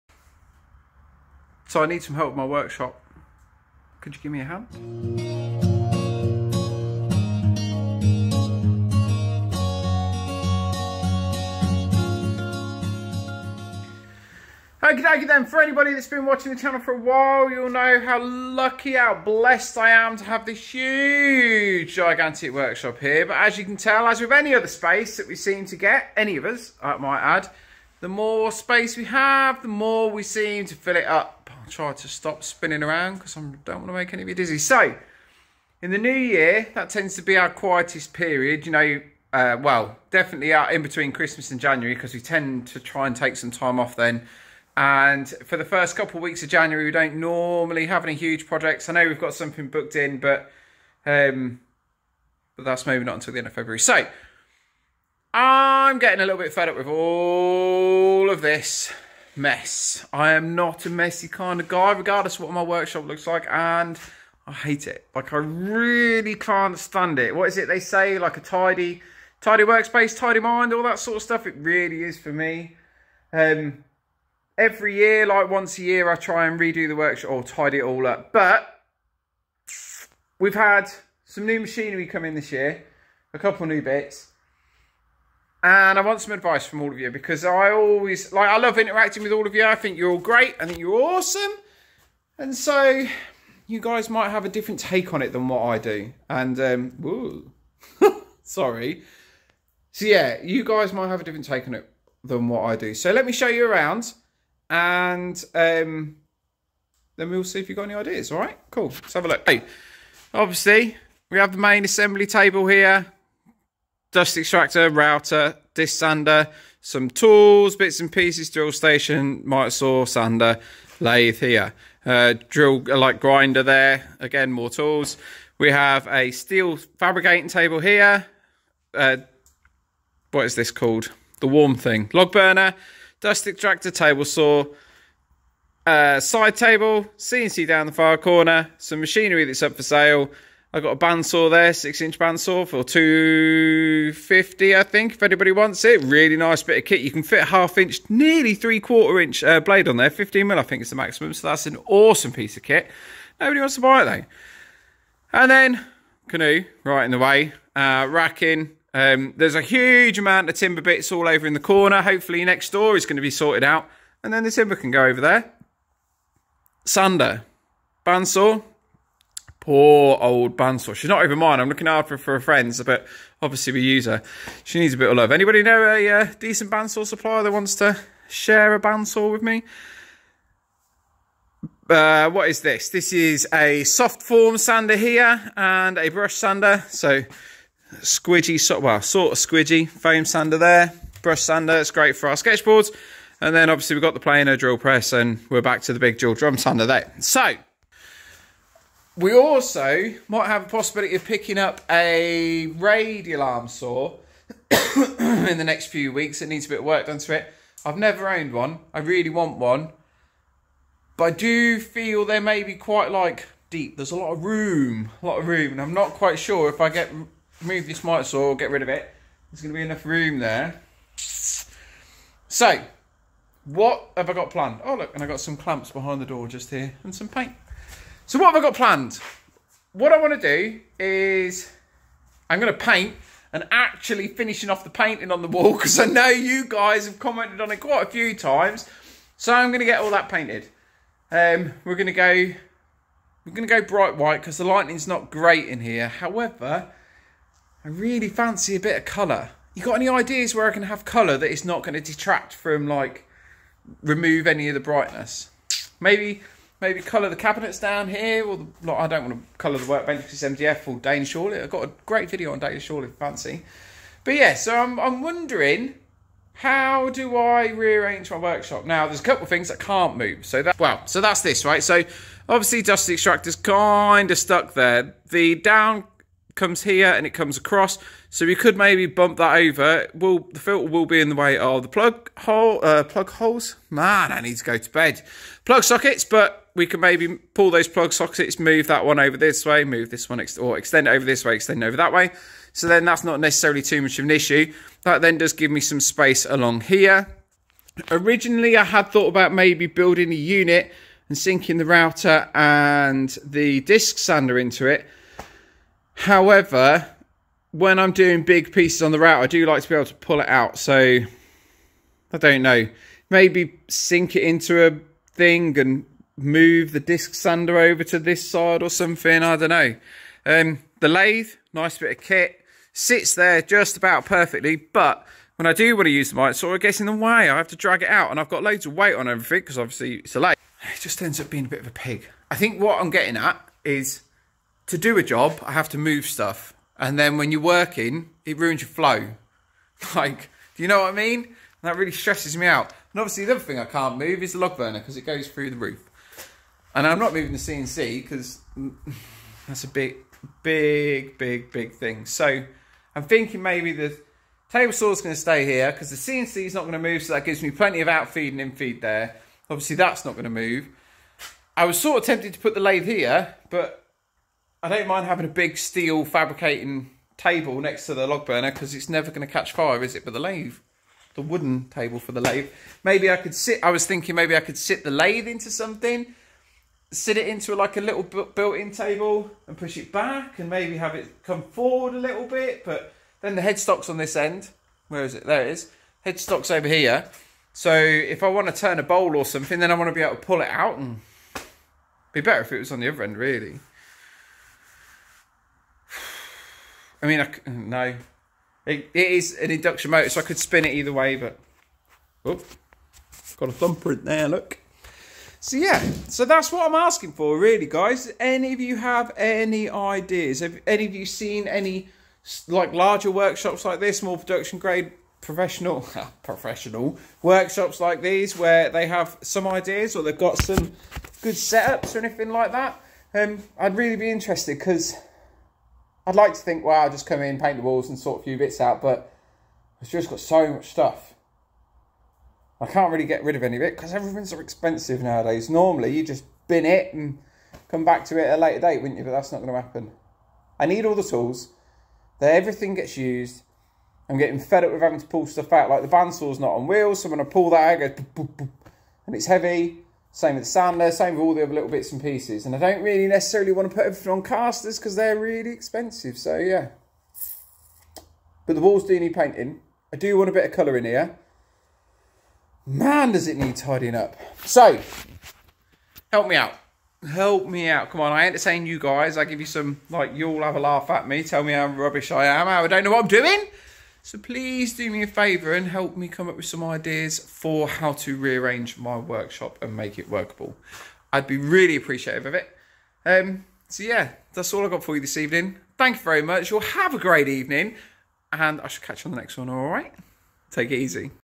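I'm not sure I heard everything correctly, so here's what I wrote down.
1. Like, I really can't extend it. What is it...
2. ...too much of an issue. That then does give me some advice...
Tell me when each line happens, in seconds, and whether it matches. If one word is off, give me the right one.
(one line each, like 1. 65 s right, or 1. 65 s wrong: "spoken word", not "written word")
1. 65 s wrong: "stand", not "extend"
2. 293 s wrong: "space", not "advice".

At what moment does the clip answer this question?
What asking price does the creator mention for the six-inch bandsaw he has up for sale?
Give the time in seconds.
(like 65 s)
142 s.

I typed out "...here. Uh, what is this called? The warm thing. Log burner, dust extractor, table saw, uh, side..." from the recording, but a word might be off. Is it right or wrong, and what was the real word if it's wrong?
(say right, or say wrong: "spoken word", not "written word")
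right.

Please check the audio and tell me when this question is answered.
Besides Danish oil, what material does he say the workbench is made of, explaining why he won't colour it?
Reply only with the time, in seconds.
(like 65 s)
260 s.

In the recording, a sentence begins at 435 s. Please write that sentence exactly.
Normally, you just bin it and come back to it at a later date, wouldn't you?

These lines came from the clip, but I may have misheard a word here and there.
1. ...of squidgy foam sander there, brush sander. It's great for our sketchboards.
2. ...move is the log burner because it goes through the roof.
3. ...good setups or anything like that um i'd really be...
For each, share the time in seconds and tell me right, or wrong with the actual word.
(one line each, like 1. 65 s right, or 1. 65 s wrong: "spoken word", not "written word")
1. 189 s right
2. 344 s right
3. 421 s right.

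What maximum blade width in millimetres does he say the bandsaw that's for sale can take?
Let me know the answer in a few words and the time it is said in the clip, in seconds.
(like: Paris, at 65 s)
15 mil, at 150 s.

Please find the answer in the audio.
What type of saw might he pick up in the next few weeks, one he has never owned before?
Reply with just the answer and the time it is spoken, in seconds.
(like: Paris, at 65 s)
Radial arm saw, at 202 s.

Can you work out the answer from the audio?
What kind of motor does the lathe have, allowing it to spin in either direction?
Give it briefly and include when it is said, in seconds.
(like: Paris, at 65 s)
Induction motor, at 399 s.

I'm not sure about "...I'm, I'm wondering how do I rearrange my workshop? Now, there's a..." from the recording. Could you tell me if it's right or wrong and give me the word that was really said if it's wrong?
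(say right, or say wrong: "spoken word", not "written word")
right.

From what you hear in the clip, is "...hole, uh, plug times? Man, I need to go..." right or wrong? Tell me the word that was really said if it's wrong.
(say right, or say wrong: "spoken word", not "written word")
wrong: "holes", not "times".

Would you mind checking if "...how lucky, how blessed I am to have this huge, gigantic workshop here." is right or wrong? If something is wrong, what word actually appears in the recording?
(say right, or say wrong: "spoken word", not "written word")
right.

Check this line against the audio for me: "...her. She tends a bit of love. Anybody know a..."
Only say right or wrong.
wrong.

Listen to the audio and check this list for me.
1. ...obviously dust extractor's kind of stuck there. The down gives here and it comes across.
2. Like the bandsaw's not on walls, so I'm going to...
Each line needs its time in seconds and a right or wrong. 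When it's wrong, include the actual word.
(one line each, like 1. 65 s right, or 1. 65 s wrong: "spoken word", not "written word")
1. 272 s wrong: "comes", not "gives"
2. 445 s wrong: "wheels", not "walls".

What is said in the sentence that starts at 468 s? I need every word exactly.
Come on, I entertain you guys.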